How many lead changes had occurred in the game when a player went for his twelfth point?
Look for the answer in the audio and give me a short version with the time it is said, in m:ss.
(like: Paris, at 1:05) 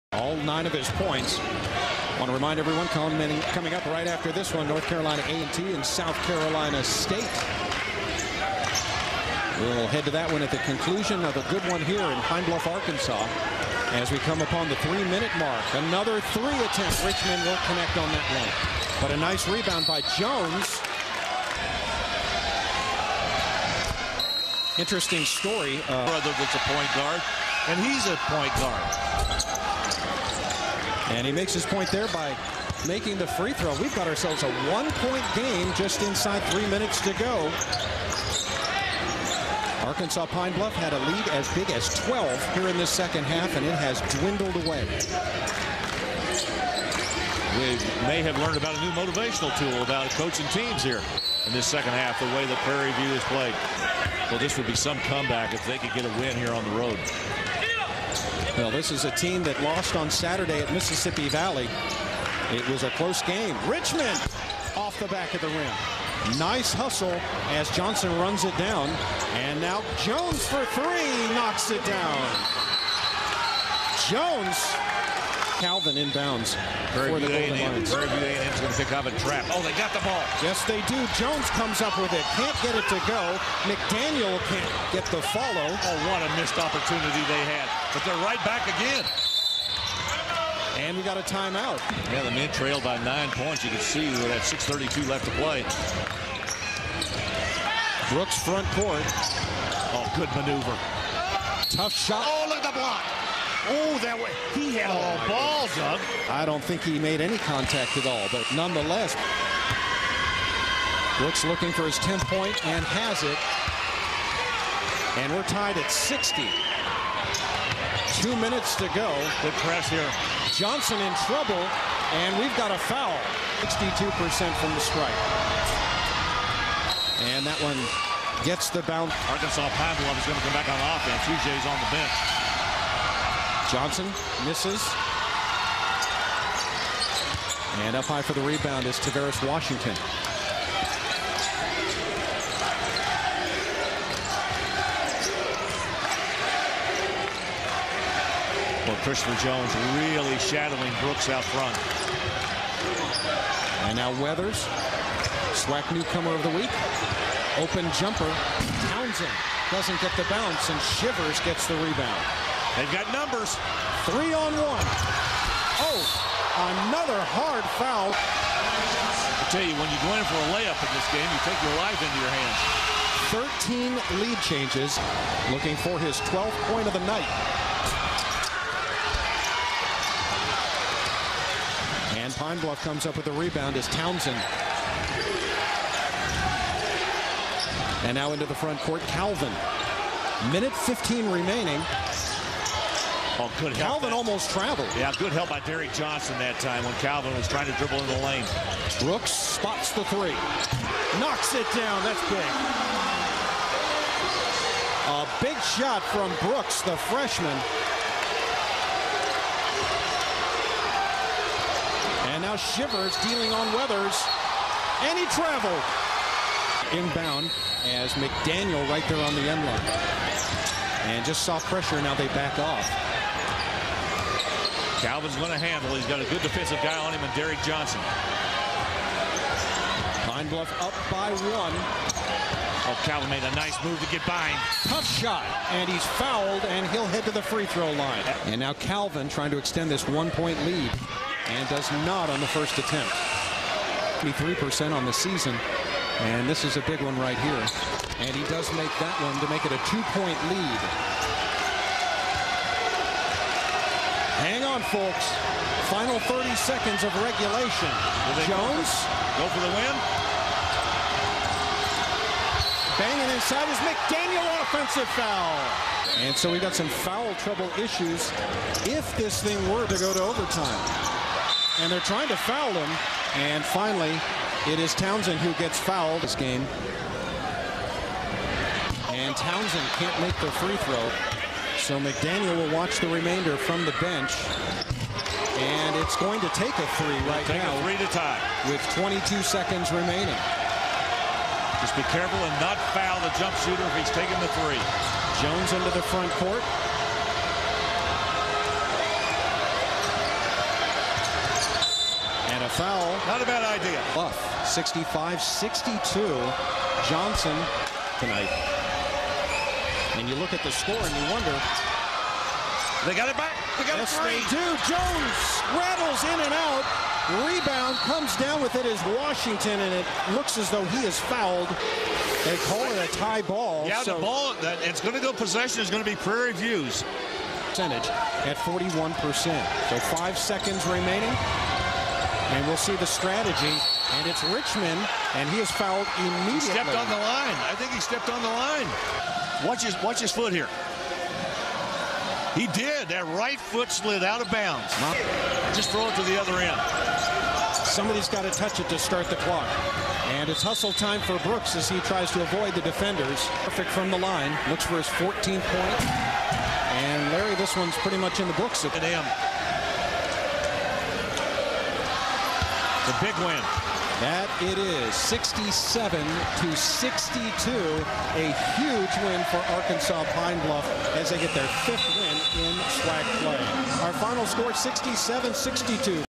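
13, at 2:53.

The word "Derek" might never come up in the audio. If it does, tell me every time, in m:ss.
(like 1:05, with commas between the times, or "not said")
3:15, 3:47.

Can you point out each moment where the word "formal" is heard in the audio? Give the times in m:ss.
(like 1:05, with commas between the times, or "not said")
not said.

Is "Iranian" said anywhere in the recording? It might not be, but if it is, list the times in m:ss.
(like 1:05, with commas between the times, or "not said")
not said.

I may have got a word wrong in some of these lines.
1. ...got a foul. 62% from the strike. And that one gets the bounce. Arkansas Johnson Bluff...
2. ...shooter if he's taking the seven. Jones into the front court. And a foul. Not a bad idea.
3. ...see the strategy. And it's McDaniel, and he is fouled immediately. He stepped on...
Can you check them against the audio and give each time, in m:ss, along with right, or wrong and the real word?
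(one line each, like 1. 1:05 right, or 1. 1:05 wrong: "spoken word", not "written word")
1. 2:02 wrong: "Pine", not "Johnson"
2. 4:53 wrong: "three", not "seven"
3. 5:32 wrong: "Richmond", not "McDaniel".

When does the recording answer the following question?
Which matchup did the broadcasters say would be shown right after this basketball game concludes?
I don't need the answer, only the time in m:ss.
0:04.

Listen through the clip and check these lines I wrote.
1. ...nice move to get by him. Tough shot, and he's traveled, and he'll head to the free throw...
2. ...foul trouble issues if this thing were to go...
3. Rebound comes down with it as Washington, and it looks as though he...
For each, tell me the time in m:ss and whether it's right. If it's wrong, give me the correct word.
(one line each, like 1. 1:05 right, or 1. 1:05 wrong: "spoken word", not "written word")
1. 3:53 wrong: "fouled", not "traveled"
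2. 4:26 right
3. 5:17 right.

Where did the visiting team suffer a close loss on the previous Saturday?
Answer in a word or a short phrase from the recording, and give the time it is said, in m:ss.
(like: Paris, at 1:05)
Mississippi Valley, at 1:00.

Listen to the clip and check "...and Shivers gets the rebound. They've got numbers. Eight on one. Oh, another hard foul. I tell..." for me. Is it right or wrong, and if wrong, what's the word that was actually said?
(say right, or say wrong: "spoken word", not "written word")
wrong: "Three", not "Eight".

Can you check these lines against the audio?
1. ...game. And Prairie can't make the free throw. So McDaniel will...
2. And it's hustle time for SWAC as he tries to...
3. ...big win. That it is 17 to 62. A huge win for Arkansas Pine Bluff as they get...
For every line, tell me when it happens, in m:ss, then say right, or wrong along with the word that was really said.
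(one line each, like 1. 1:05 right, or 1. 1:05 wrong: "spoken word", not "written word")
1. 4:36 wrong: "Townsend", not "Prairie"
2. 5:50 wrong: "Brooks", not "SWAC"
3. 6:03 wrong: "67", not "17".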